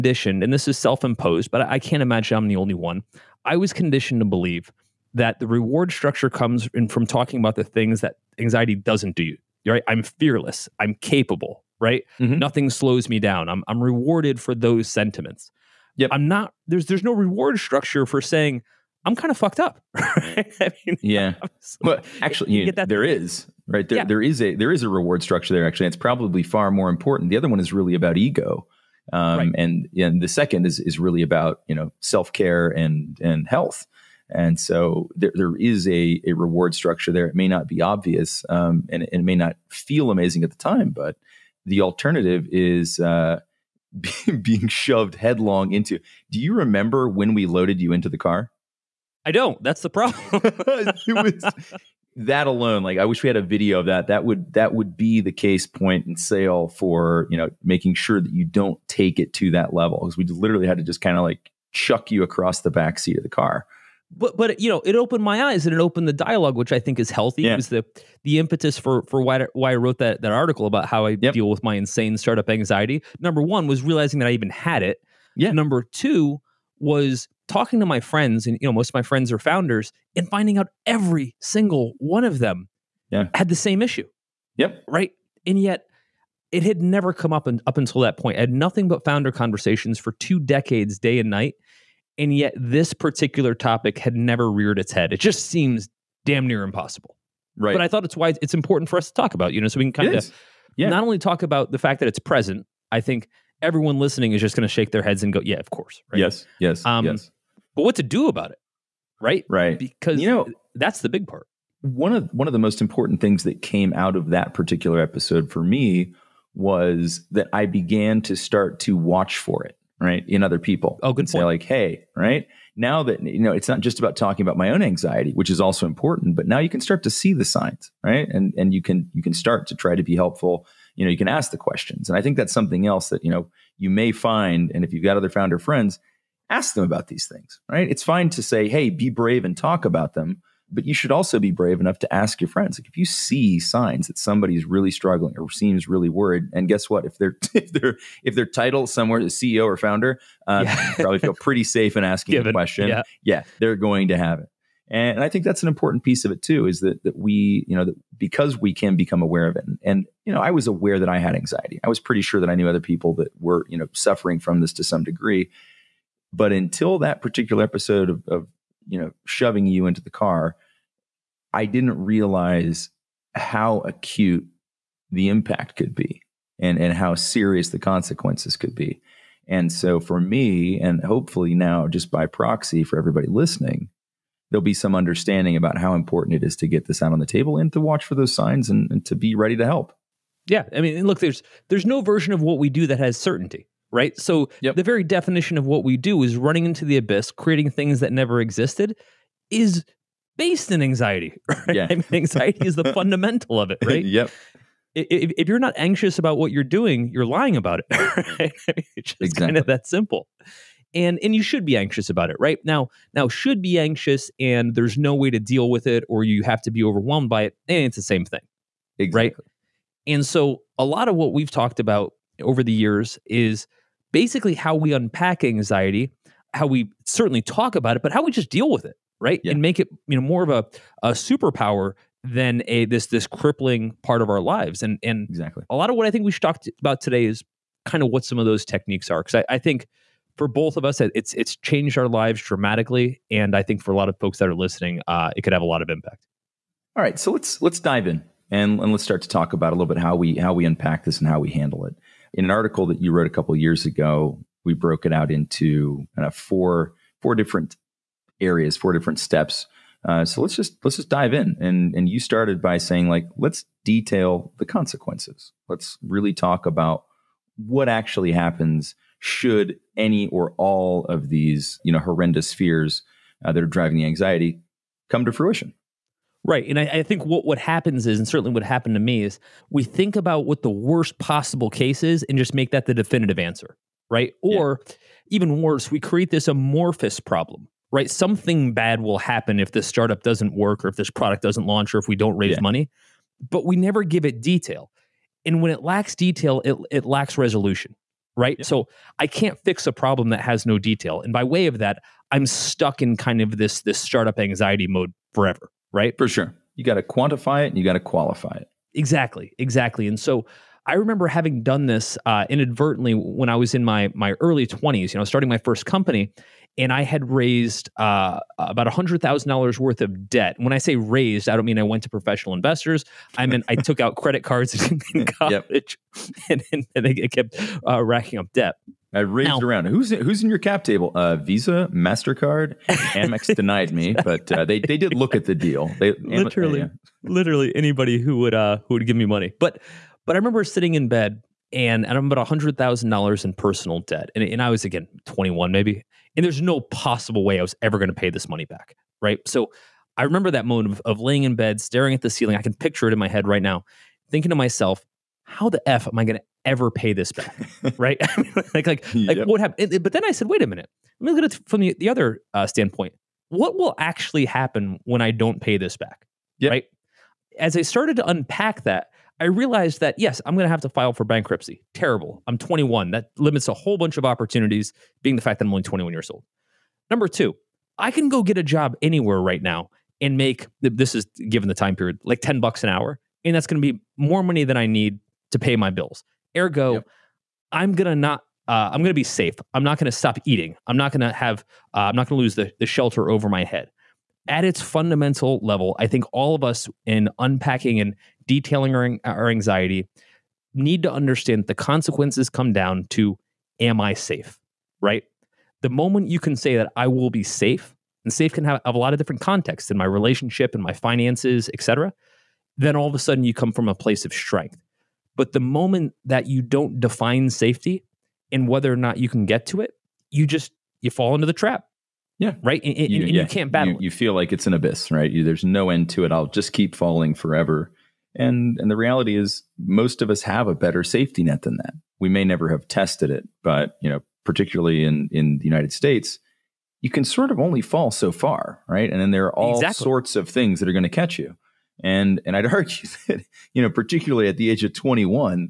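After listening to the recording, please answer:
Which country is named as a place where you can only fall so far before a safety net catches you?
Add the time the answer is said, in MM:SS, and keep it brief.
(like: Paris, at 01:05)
United States, at 07:15.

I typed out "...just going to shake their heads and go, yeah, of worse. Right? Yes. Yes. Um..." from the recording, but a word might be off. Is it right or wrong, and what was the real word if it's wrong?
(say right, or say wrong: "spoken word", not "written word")
wrong: "course", not "worse".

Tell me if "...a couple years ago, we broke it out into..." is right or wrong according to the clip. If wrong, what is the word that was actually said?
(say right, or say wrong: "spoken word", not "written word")
right.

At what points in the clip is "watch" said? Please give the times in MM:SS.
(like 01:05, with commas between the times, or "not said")
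01:58, 03:07.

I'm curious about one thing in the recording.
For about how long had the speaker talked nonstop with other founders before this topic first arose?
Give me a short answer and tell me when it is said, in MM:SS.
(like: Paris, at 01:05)
two decades, at 01:30.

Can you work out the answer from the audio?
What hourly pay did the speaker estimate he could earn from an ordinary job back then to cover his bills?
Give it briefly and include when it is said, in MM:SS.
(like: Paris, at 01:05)
$10 an hour, at 06:22.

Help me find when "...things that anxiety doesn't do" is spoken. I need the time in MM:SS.
00:07.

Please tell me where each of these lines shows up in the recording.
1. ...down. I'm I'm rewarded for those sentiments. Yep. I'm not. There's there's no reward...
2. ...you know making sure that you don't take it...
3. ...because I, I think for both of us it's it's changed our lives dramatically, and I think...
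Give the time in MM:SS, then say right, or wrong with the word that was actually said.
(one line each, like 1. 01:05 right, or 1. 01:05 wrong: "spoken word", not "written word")
1. 00:13 right
2. 00:57 right
3. 03:59 right.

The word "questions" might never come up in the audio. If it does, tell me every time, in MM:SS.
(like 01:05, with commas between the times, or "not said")
02:11, 02:32.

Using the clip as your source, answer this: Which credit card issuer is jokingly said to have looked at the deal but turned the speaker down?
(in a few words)
Amex.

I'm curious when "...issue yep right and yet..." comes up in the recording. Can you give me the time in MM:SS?
01:23.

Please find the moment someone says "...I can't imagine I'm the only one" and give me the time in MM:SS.
00:01.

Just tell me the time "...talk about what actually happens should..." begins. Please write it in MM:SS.
04:26.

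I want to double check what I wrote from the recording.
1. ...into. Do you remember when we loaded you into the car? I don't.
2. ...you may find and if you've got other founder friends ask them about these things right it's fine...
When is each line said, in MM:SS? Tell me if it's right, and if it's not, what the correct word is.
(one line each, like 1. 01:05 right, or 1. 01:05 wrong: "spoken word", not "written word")
1. 00:45 right
2. 02:13 right.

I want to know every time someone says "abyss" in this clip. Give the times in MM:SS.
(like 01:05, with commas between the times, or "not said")
03:16, 07:04.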